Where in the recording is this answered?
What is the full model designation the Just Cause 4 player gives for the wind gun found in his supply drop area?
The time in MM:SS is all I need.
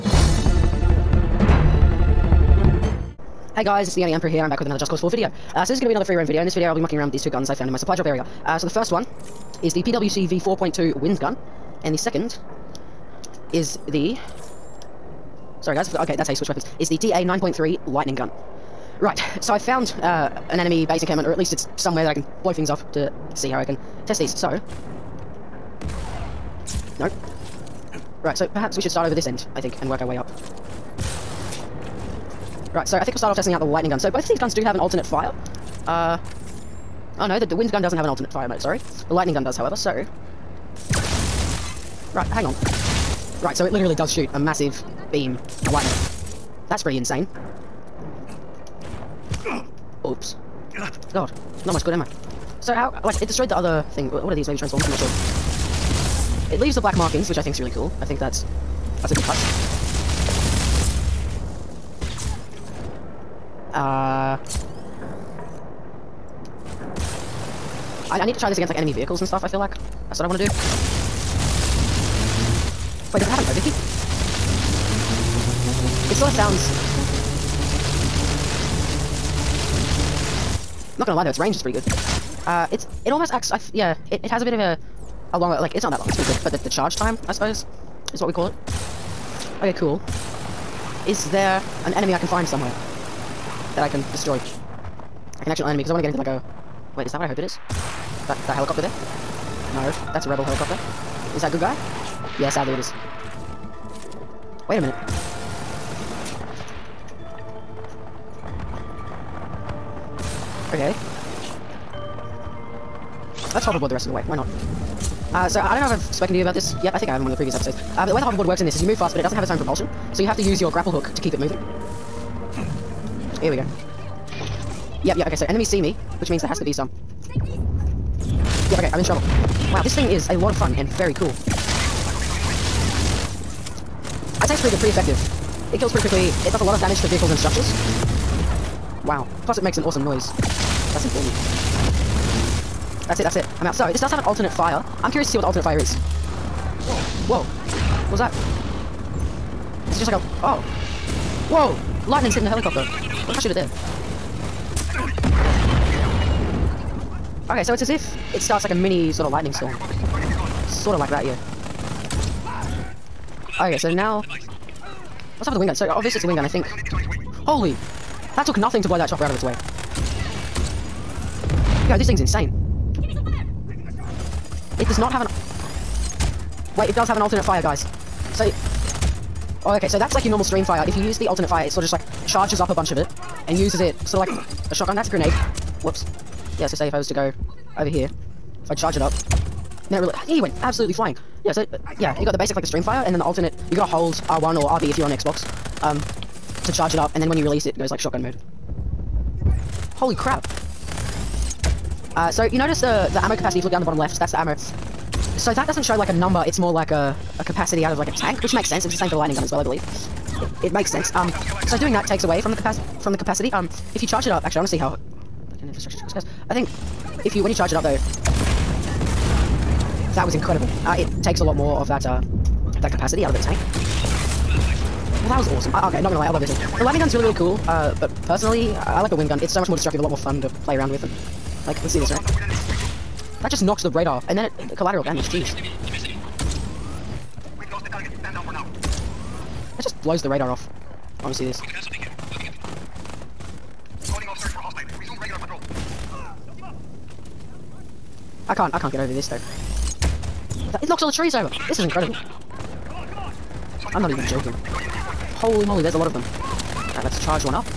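00:09.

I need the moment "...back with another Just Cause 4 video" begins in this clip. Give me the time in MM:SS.
00:04.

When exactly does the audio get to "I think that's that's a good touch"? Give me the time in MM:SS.
00:58.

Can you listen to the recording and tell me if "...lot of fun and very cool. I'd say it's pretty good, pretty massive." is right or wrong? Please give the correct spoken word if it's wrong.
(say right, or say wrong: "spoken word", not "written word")
wrong: "effective", not "massive".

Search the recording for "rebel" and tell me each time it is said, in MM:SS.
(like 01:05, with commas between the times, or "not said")
01:40.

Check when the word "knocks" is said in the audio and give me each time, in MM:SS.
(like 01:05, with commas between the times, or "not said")
03:53, 04:10.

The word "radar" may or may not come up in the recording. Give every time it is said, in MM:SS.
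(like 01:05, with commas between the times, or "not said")
03:53, 04:00.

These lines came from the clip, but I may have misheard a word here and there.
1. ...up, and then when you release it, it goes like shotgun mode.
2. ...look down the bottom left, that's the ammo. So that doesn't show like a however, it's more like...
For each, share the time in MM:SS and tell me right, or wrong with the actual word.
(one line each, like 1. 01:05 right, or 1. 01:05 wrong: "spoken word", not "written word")
1. 03:16 right
2. 03:23 wrong: "number", not "however".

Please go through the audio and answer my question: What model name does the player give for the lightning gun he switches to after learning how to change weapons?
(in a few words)
DA 9.3.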